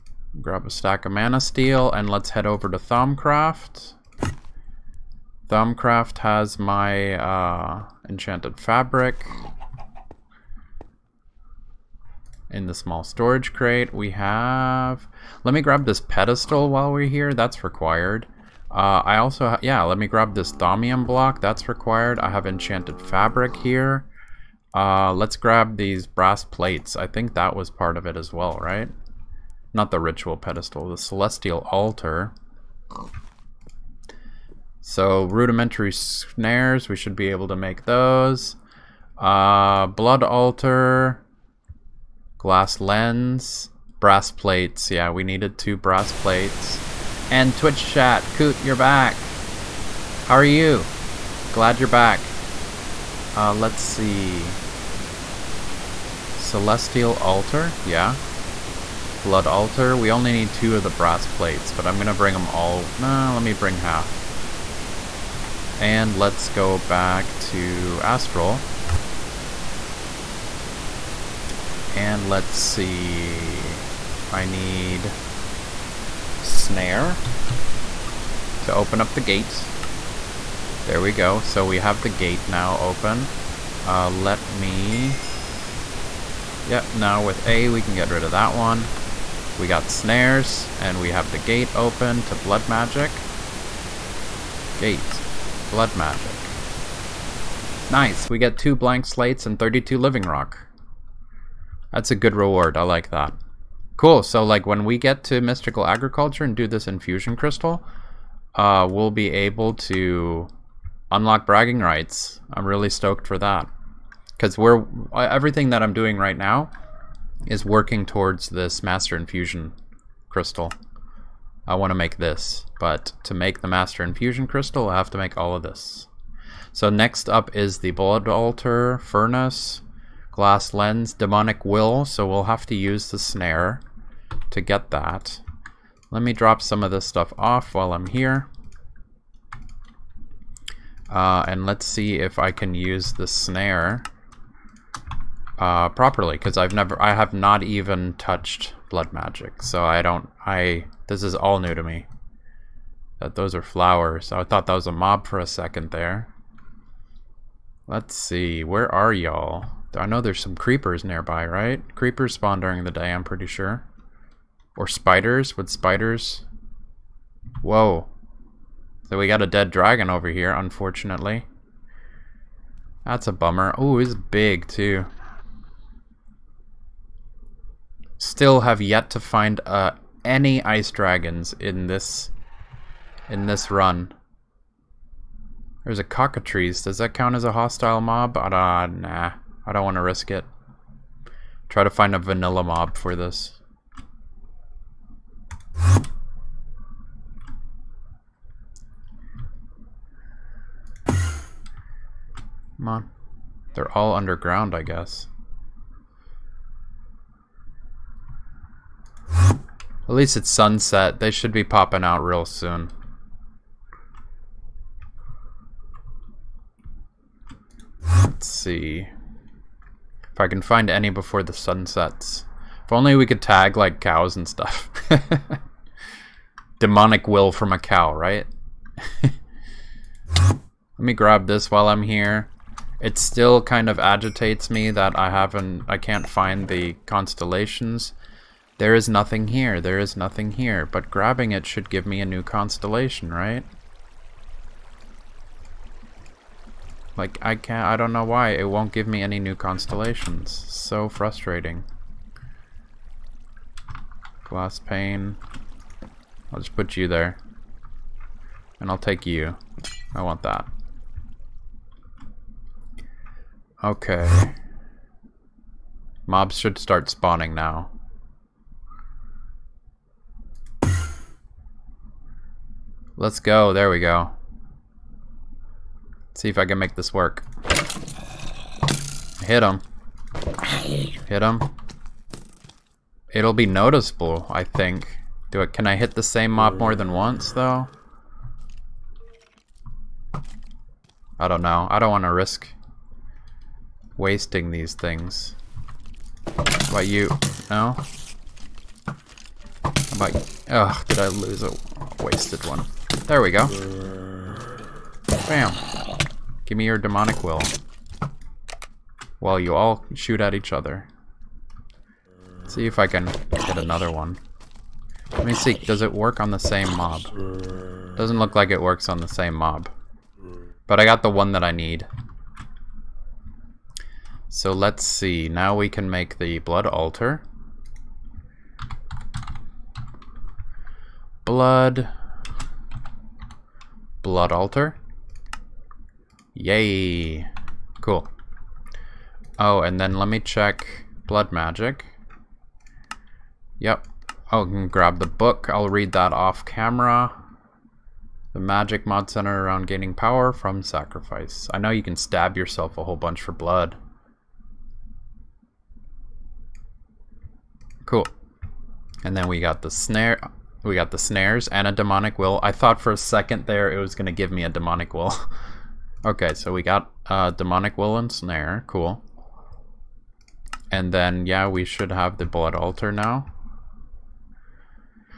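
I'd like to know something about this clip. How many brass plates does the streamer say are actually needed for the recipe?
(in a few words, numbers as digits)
2.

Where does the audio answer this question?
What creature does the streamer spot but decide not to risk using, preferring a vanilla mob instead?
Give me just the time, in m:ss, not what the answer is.
3:06.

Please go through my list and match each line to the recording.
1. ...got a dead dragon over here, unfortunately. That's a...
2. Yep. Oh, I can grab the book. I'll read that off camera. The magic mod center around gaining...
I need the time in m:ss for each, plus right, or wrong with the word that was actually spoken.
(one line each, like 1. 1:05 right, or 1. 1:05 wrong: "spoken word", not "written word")
1. 2:49 right
2. 5:43 right.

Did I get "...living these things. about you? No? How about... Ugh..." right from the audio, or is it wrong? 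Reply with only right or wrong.
wrong.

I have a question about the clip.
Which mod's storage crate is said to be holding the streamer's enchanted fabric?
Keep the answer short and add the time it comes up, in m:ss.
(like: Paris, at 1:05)
Thaumcraft, at 0:05.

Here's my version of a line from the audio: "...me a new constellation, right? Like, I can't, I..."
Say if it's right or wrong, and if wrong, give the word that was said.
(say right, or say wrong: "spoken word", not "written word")
right.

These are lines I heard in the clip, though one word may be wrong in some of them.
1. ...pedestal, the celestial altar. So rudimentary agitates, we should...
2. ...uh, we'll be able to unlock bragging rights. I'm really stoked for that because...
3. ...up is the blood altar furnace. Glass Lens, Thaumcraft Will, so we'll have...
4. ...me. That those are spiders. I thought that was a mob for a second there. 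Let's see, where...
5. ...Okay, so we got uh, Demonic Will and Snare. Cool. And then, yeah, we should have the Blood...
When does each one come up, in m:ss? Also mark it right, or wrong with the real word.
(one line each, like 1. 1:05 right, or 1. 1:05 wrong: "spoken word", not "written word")
1. 0:30 wrong: "snares", not "agitates"
2. 1:48 right
3. 2:07 wrong: "Demonic", not "Thaumcraft"
4. 2:31 wrong: "flowers", not "spiders"
5. 6:06 right.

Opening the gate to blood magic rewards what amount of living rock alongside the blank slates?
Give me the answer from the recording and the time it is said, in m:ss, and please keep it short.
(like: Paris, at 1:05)
32, at 1:39.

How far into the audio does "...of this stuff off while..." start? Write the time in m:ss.
2:16.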